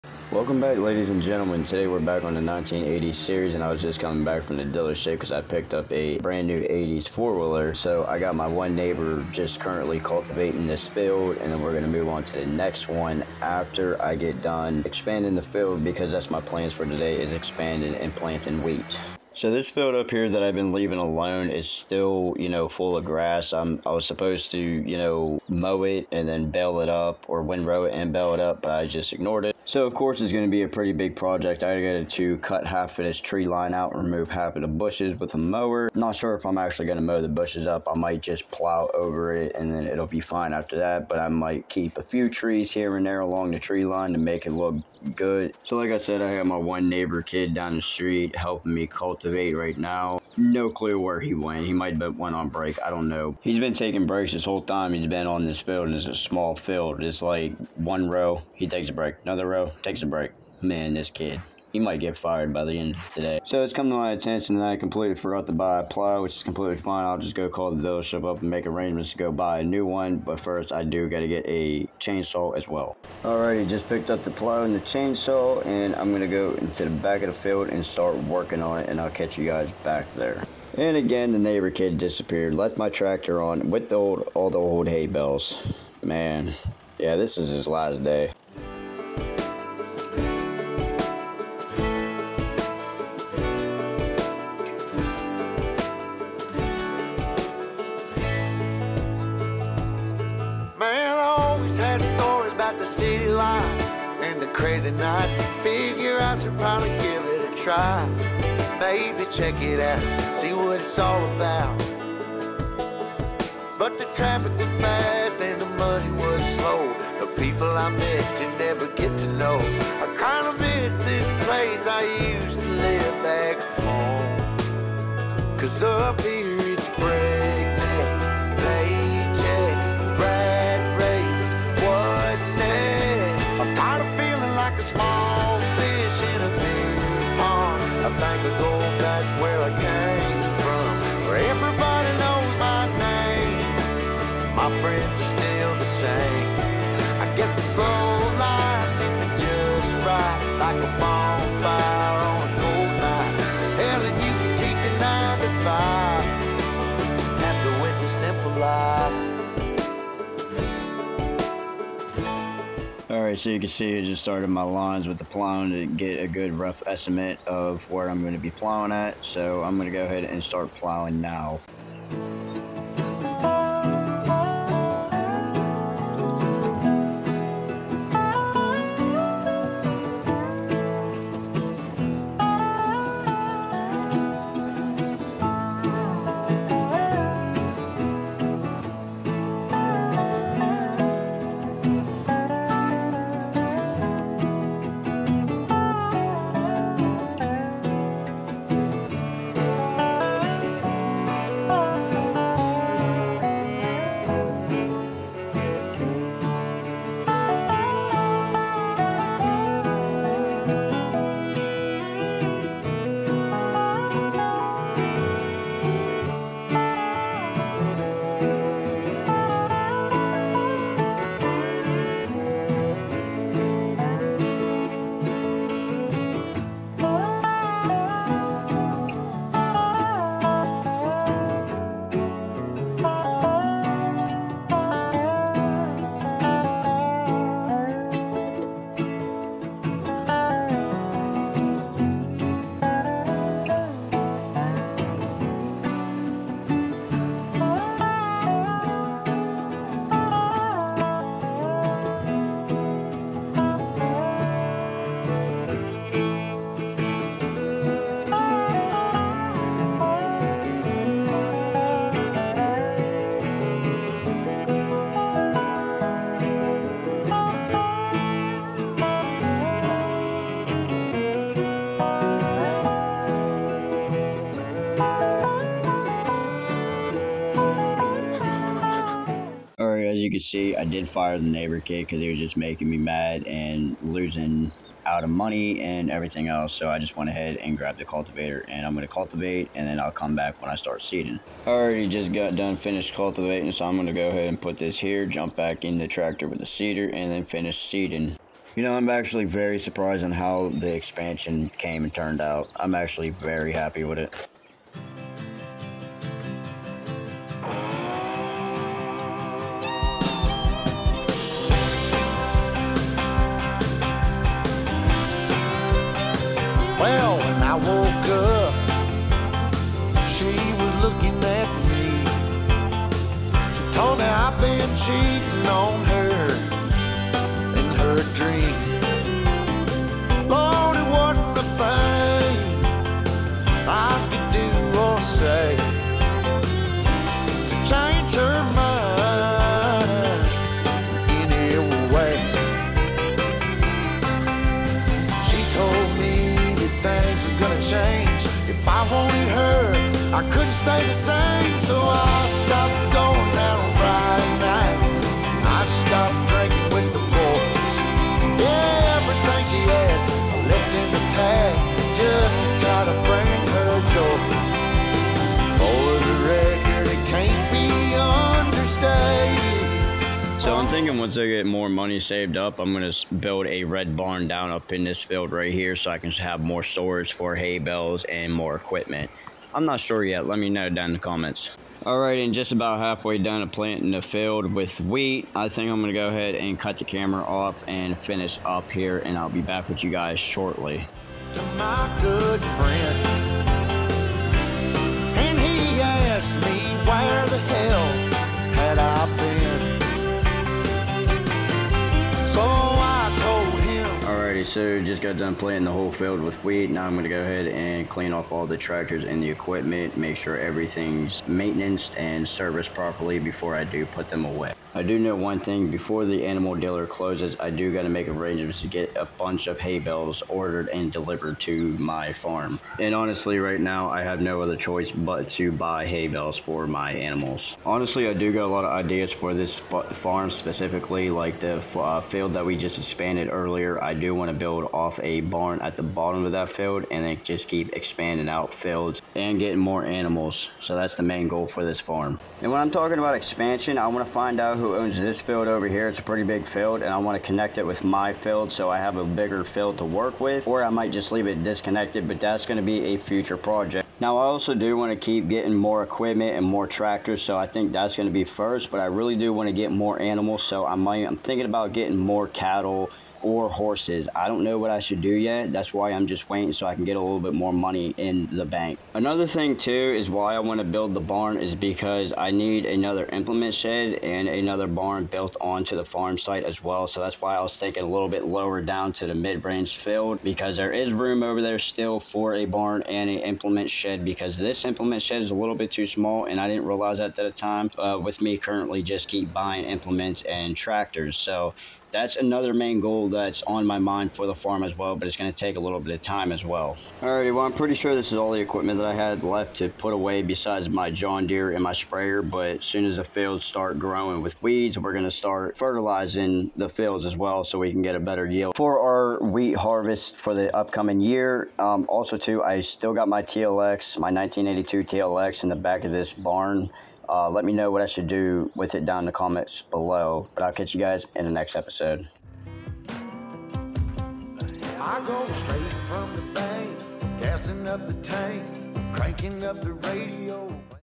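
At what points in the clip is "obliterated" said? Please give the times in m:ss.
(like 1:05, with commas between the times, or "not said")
not said.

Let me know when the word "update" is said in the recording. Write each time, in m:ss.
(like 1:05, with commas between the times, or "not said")
not said.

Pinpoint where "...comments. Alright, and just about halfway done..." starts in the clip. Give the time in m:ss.
6:21.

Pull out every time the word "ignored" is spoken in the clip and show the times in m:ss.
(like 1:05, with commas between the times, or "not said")
0:29.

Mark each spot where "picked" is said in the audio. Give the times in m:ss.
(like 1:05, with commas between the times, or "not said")
0:05, 1:13.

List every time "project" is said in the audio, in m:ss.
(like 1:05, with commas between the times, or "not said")
0:31, 7:33.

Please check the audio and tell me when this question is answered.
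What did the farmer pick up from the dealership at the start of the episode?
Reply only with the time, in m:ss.
0:06.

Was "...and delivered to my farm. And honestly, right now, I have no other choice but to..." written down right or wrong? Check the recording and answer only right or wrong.
right.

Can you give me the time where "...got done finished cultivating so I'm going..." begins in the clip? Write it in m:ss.
4:52.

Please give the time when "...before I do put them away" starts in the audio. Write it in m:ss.
6:53.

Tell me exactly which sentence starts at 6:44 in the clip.
so just got done planting the whole field with wheat.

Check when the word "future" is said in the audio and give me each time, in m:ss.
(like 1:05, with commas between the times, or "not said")
7:33.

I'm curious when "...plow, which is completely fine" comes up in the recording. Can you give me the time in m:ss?
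1:05.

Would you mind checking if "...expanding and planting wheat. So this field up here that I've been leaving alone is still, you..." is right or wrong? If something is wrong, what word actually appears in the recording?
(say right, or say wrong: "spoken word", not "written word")
right.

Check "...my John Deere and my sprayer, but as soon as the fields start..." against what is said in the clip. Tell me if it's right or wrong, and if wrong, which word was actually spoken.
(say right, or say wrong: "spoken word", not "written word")
right.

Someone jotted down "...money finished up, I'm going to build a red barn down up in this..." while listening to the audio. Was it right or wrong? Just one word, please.
wrong.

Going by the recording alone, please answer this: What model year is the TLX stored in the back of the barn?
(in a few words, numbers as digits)
1982.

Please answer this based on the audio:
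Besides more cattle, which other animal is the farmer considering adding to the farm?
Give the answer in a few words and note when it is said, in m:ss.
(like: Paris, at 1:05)
Horses, at 7:43.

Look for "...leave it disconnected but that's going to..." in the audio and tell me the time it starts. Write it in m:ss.
7:31.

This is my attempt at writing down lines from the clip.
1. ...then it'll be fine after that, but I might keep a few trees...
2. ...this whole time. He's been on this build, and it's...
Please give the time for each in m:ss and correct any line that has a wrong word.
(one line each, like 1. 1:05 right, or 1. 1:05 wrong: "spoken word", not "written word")
1. 0:39 right
2. 0:54 wrong: "field", not "build".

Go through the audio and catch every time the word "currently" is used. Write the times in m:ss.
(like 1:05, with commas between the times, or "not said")
0:09, 8:08.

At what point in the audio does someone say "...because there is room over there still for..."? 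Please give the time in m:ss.
8:00.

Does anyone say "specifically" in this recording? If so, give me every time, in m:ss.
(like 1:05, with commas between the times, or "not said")
7:10.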